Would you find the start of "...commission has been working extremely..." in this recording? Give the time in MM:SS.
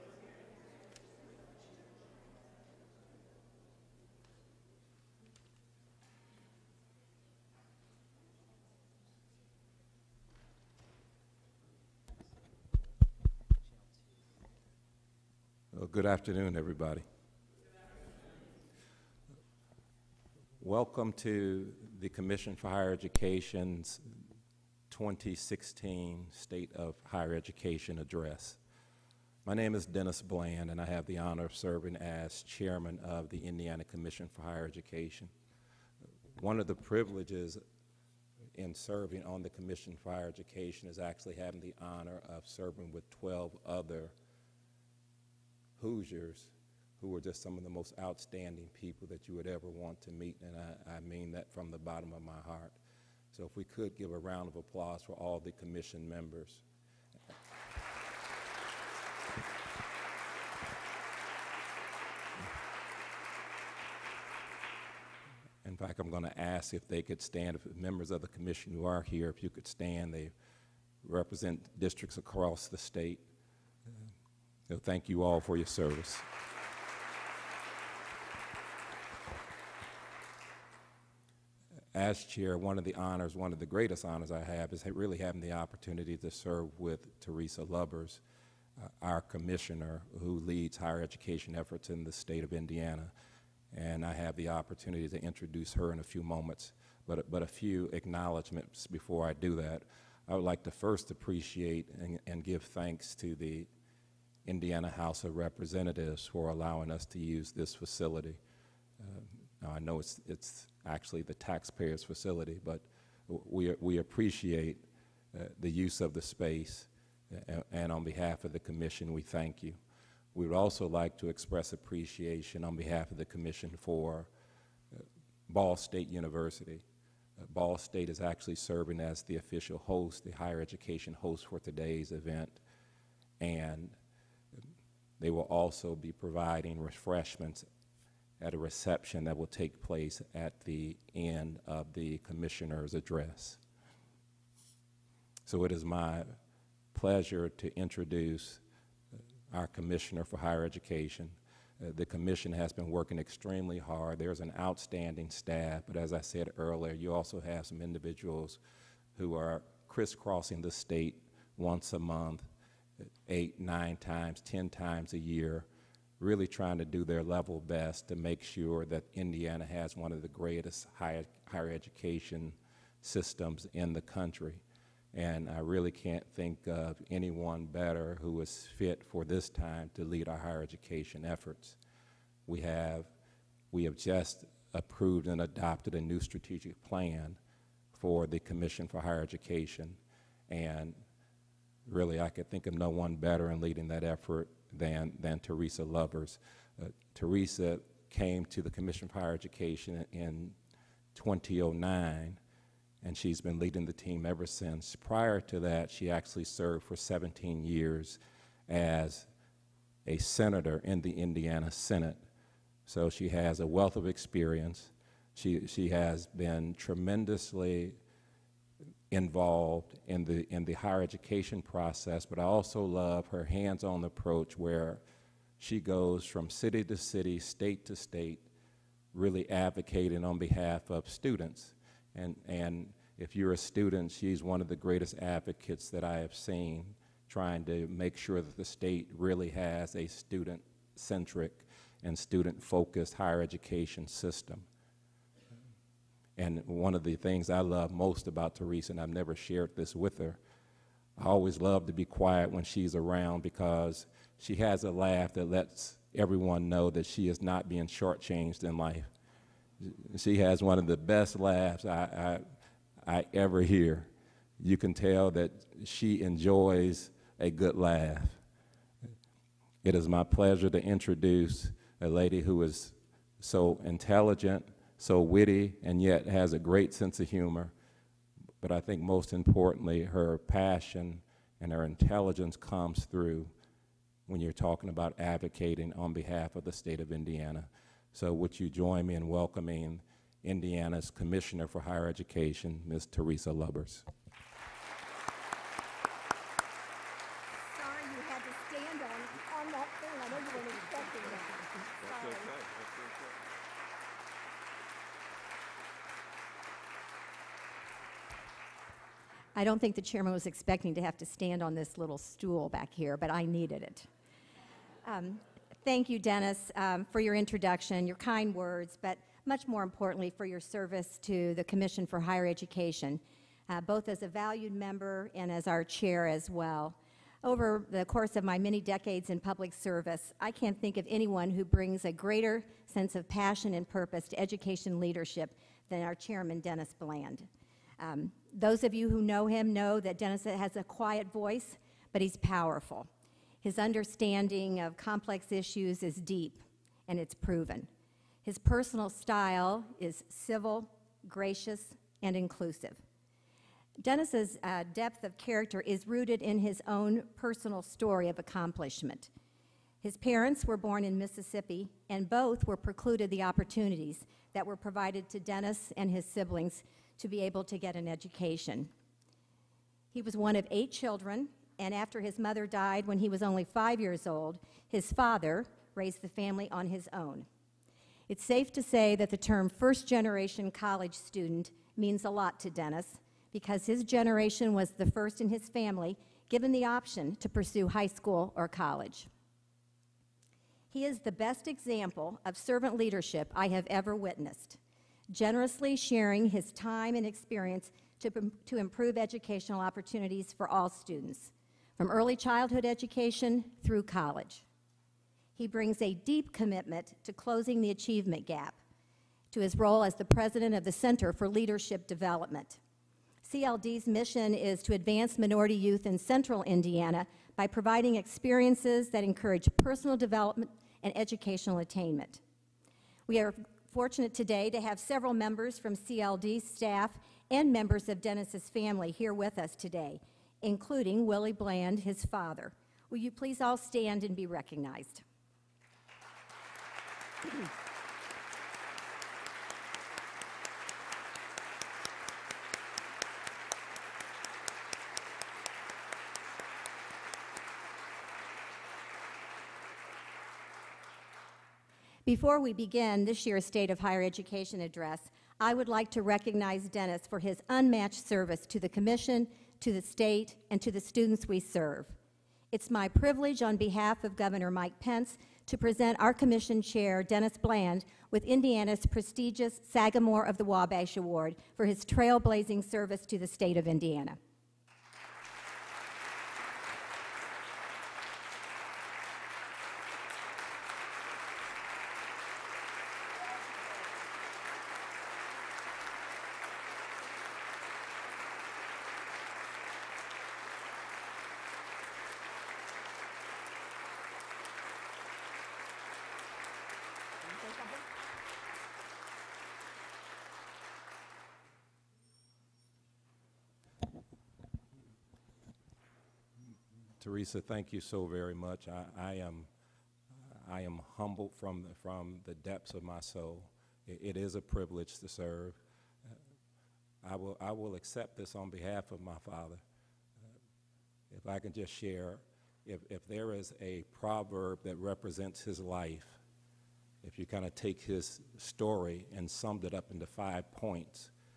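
02:32.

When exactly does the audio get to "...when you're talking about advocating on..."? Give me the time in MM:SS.
04:44.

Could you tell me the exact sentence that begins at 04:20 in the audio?
She has one of the best laughs I, I, I ever hear.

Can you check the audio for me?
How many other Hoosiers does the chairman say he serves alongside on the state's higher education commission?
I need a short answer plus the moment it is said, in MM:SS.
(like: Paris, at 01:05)
12, at 00:43.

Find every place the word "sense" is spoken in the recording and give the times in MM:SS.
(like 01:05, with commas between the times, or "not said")
04:36, 05:32.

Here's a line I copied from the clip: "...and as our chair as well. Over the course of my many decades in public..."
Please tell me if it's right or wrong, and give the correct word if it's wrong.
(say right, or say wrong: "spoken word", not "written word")
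right.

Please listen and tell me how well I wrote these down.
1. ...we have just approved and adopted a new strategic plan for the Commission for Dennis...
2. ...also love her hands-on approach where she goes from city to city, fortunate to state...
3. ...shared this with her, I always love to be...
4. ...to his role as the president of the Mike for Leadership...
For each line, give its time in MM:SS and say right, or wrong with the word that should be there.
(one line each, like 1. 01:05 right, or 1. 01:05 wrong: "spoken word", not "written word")
1. 03:03 wrong: "Higher", not "Dennis"
2. 03:42 wrong: "state", not "fortunate"
3. 04:09 right
4. 06:49 wrong: "Center", not "Mike".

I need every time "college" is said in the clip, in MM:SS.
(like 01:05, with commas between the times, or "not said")
06:20, 06:28, 06:44.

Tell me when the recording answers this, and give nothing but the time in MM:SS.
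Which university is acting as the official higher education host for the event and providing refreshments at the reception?
02:05.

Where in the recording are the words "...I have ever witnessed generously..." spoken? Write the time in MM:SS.
06:33.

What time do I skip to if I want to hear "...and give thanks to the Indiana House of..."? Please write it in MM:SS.
01:42.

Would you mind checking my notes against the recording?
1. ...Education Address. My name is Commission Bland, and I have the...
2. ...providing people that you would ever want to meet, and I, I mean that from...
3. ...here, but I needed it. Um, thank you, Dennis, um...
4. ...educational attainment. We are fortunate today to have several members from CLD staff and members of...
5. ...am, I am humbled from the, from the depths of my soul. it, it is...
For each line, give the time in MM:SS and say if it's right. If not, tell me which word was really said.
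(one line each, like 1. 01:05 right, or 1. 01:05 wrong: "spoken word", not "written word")
1. 00:27 wrong: "Dennis", not "Commission"
2. 00:48 wrong: "outstanding", not "providing"
3. 05:12 right
4. 07:01 right
5. 08:29 right.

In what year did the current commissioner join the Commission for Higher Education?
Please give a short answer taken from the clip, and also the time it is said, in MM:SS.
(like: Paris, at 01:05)
2009, at 03:21.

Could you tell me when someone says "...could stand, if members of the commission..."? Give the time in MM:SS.
01:07.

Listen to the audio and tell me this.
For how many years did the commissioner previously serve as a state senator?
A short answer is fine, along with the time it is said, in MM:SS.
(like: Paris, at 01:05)
17, at 03:26.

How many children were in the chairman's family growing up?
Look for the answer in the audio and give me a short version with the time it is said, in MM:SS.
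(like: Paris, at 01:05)
8, at 06:10.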